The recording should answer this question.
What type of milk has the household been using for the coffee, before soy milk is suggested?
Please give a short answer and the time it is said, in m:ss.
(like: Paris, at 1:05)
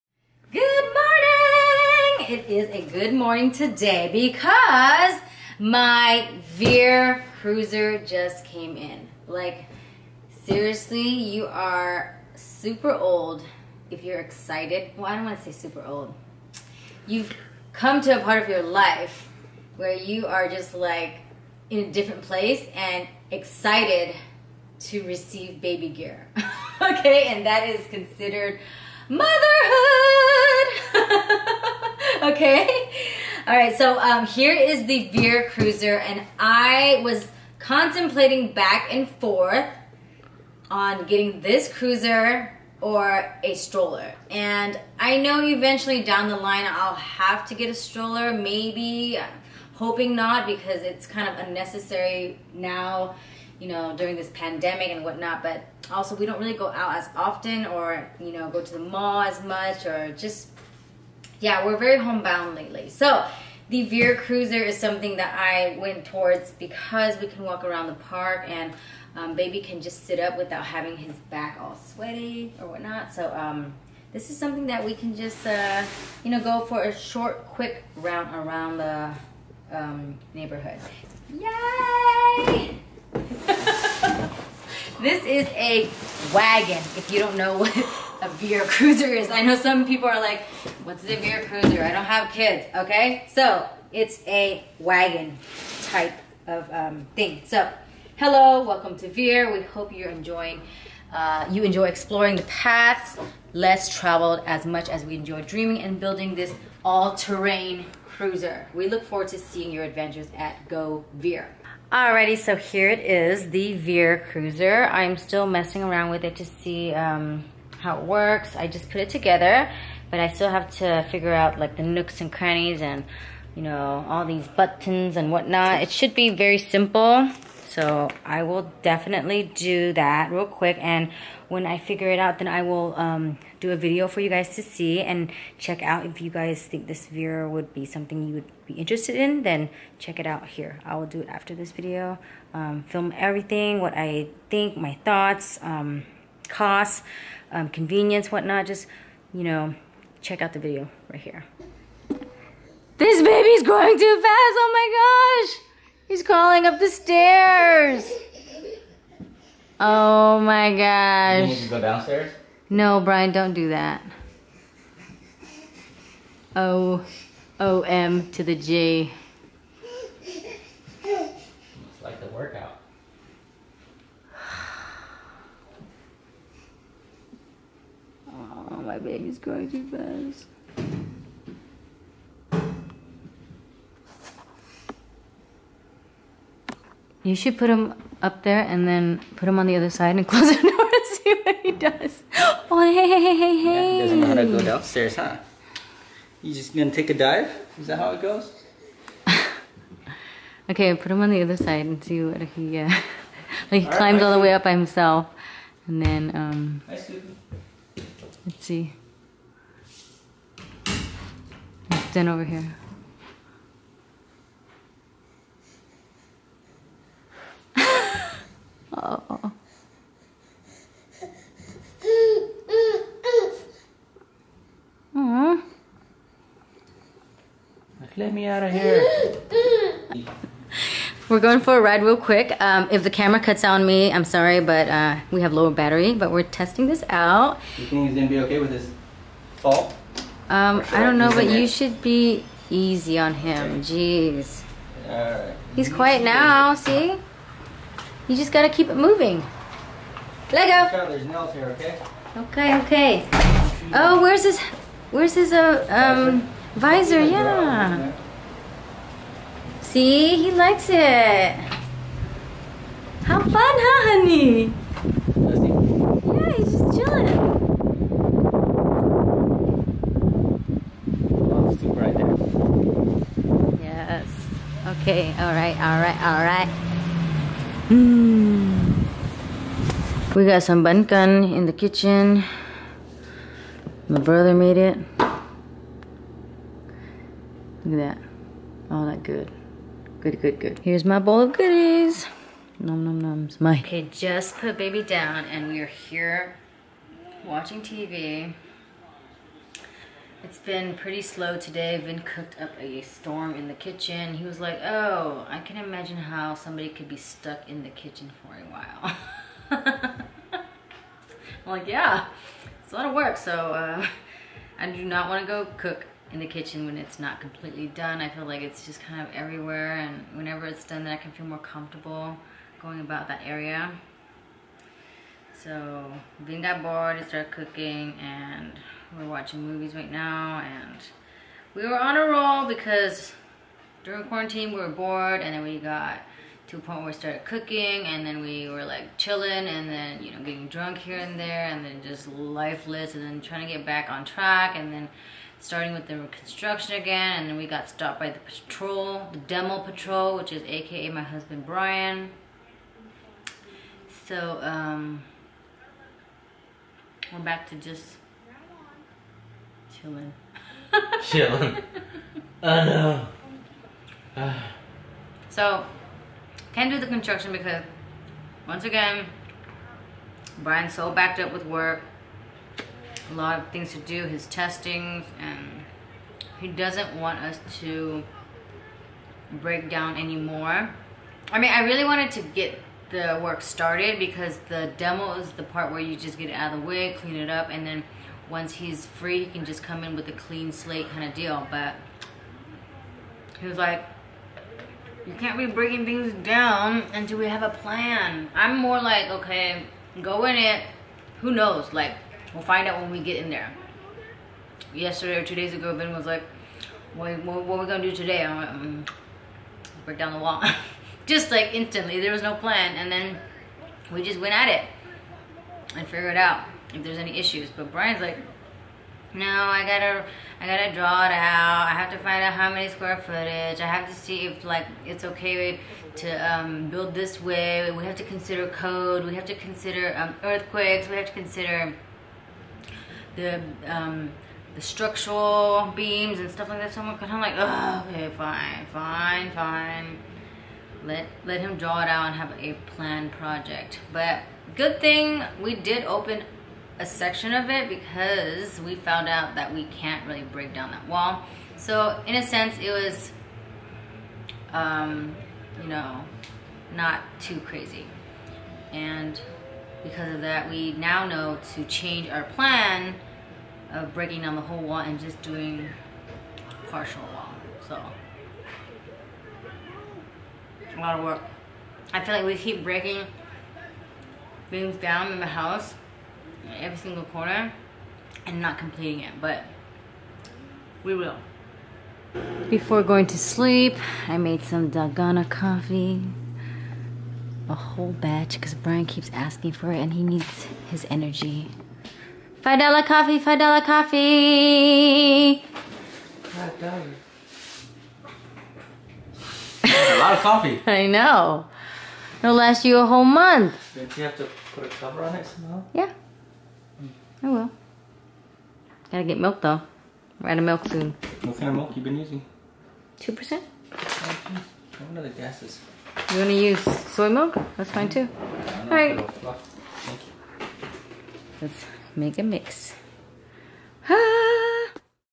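2%, at 8:33.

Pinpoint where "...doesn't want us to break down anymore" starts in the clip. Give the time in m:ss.
6:16.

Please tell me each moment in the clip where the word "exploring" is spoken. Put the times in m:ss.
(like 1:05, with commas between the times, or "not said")
1:41.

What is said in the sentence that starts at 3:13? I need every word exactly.
Yeah, doesn't know how to go downstairs, huh?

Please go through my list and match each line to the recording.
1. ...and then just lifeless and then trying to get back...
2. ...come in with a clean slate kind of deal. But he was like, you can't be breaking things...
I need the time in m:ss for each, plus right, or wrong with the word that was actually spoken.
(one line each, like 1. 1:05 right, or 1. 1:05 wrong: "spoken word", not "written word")
1. 5:41 right
2. 6:29 right.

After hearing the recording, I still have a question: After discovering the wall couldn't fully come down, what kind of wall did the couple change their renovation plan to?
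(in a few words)
partial wall.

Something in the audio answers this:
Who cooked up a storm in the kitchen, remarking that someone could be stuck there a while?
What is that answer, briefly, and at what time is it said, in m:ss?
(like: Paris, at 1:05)
Vinh, at 5:02.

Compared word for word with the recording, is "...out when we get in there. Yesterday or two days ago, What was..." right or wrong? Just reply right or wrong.
wrong.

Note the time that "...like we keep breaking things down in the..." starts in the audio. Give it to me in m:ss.
7:52.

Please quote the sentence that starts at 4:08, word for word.
You just gotta keep it moving.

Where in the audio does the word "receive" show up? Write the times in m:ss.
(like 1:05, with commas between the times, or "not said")
0:25.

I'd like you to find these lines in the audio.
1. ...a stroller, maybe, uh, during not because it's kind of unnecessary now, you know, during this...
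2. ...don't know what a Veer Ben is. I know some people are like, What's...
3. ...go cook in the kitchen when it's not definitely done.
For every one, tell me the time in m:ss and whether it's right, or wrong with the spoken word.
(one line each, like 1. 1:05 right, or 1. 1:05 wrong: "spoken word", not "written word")
1. 0:47 wrong: "hoping", not "during"
2. 1:27 wrong: "Cruiser", not "Ben"
3. 5:15 wrong: "completely", not "definitely".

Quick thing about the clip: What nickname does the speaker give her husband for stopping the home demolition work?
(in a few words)
the demo patrol.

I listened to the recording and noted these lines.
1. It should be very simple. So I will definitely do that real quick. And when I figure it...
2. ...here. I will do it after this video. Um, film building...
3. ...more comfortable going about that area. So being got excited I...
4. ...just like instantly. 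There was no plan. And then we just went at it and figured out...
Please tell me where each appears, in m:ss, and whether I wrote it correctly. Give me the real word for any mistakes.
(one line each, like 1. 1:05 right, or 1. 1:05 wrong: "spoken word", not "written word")
1. 2:05 right
2. 2:20 wrong: "everything", not "building"
3. 5:21 wrong: "bored", not "excited"
4. 6:51 right.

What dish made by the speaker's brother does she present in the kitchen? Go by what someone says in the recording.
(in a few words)
bunkan.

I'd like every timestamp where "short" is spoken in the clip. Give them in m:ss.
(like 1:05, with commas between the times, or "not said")
1:16.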